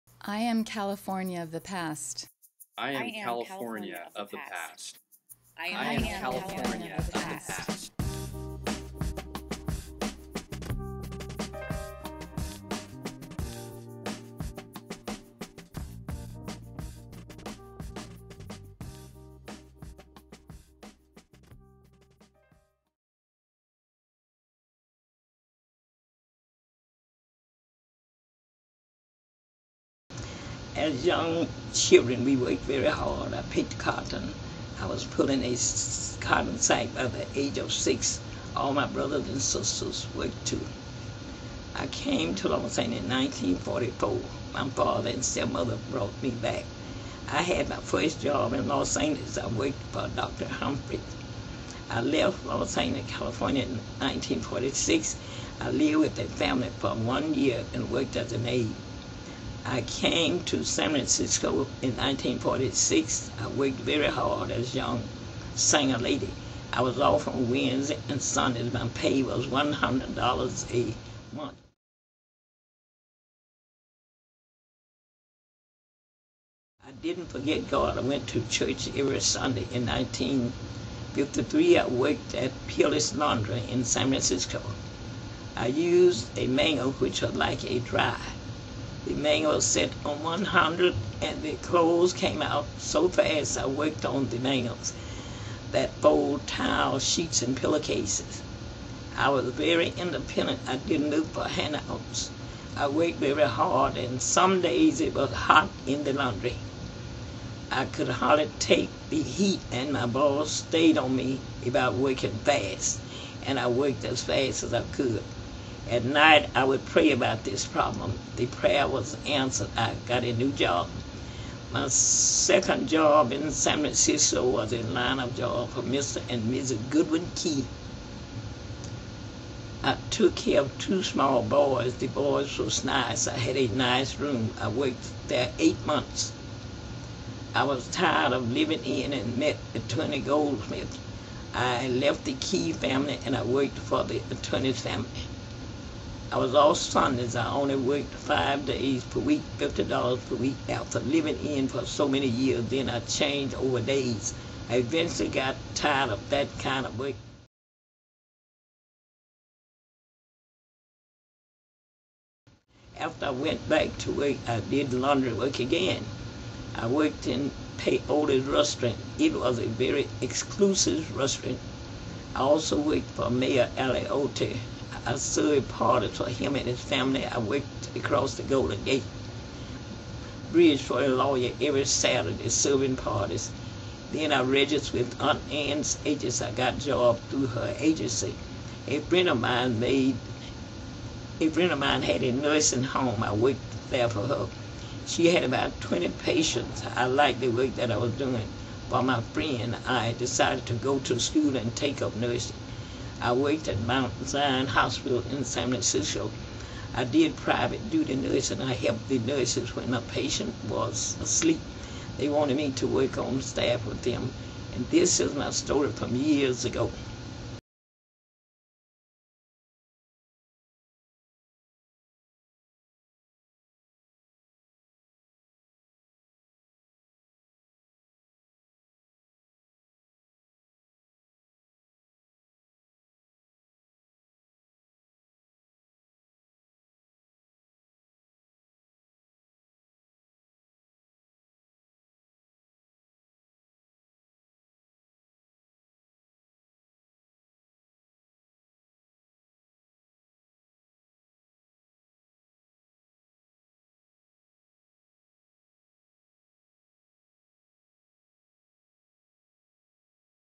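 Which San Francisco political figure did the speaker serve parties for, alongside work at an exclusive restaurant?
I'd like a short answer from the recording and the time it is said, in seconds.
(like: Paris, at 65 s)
Mayor Alioto, at 173 s.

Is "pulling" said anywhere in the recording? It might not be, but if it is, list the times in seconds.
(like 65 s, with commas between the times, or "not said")
35 s.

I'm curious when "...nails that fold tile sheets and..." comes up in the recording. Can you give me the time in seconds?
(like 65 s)
94 s.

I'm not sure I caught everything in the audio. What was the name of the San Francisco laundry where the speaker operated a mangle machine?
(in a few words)
Peerless Laundry.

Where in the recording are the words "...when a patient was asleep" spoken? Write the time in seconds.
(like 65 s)
209 s.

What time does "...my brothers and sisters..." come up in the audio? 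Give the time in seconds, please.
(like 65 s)
38 s.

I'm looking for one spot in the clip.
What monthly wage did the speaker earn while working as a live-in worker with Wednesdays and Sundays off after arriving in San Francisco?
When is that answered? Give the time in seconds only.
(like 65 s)
69 s.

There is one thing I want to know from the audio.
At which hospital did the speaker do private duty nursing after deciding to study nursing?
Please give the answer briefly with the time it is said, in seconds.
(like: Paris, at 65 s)
Mount Zion Hospital, at 203 s.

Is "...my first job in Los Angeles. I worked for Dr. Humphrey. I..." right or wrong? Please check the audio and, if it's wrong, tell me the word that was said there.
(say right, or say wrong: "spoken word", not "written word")
right.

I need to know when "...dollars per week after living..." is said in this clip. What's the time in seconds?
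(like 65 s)
149 s.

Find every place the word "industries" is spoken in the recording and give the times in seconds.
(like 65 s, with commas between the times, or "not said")
not said.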